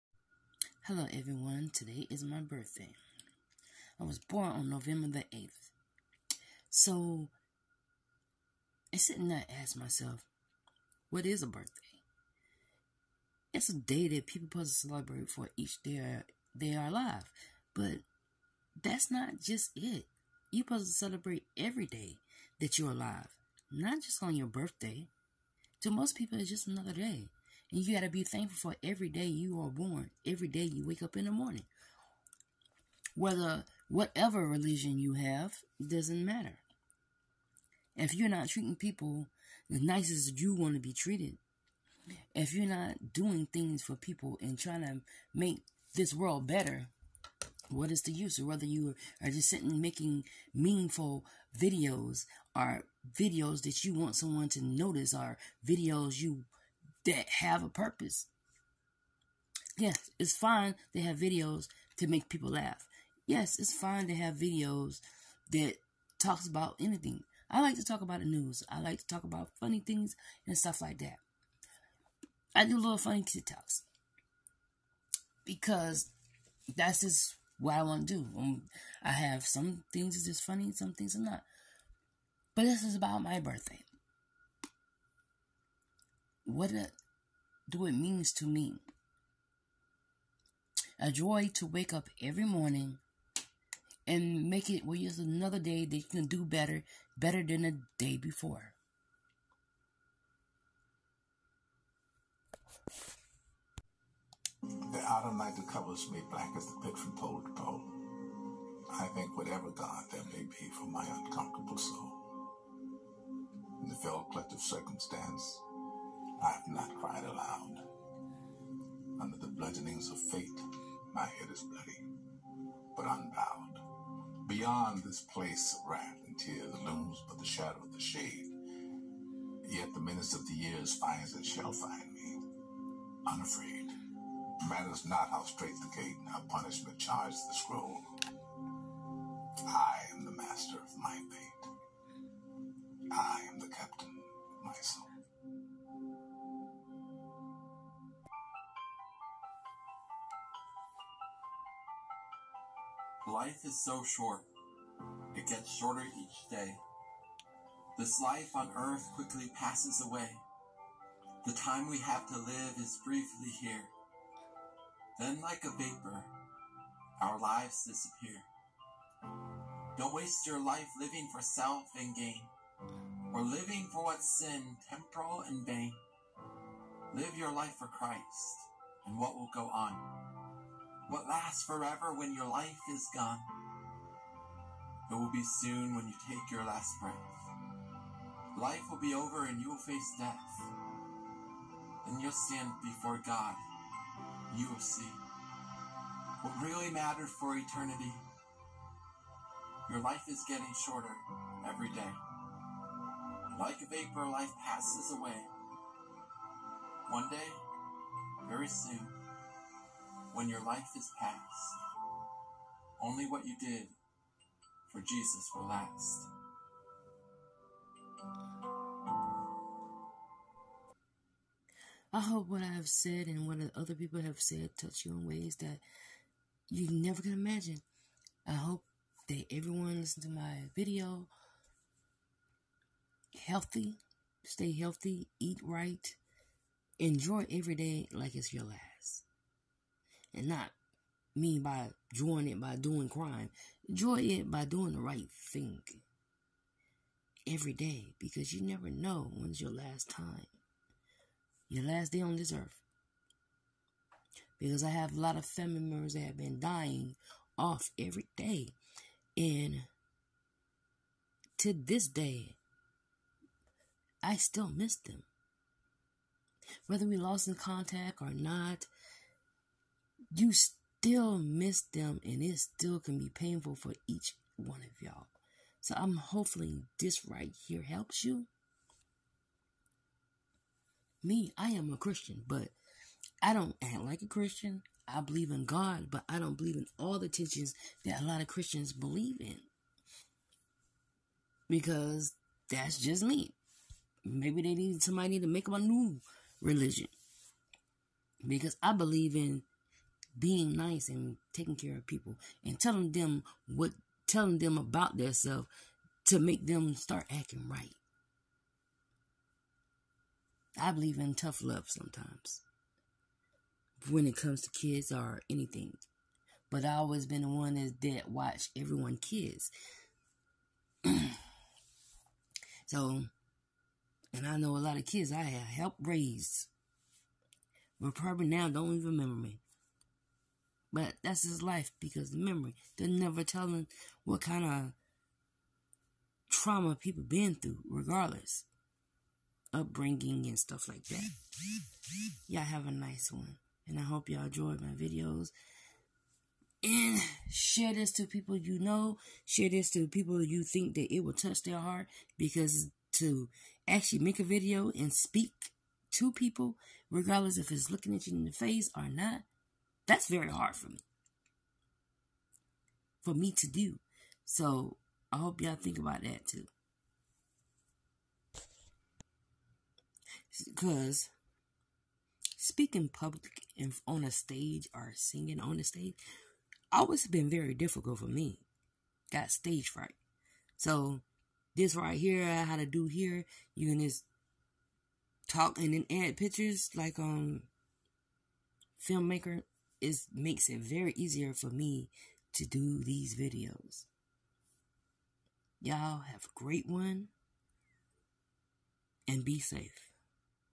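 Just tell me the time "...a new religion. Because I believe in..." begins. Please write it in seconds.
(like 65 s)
295 s.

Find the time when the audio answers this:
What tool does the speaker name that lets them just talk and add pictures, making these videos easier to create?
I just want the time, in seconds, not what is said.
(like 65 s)
389 s.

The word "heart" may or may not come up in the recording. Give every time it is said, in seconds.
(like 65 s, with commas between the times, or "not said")
351 s.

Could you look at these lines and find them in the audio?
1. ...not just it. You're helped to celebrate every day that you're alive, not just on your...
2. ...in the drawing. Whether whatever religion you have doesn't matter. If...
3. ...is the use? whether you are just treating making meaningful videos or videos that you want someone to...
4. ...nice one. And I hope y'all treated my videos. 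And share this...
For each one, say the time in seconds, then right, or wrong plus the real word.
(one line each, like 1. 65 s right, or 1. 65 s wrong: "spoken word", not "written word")
1. 19 s wrong: "supposed", not "helped"
2. 31 s wrong: "morning", not "drawing"
3. 47 s wrong: "sitting", not "treating"
4. 342 s wrong: "enjoyed", not "treated".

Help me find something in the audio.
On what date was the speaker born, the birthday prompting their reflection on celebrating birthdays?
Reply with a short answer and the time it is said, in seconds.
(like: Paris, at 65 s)
November 8, at 4 s.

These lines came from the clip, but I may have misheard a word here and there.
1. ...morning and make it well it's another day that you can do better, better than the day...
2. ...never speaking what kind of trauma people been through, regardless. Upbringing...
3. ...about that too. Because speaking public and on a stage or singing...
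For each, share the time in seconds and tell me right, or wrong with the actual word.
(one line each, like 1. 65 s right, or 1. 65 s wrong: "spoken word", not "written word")
1. 92 s right
2. 333 s wrong: "telling", not "speaking"
3. 365 s right.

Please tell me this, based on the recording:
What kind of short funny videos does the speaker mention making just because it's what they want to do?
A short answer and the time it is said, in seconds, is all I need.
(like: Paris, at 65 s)
TikToks, at 73 s.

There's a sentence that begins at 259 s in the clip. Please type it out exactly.
And to this day, I still miss them.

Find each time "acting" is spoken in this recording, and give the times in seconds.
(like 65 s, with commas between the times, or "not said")
307 s.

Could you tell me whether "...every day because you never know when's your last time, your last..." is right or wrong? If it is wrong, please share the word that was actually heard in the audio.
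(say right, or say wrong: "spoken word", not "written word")
right.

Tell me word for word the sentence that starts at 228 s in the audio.
I hope that everyone listen to my video.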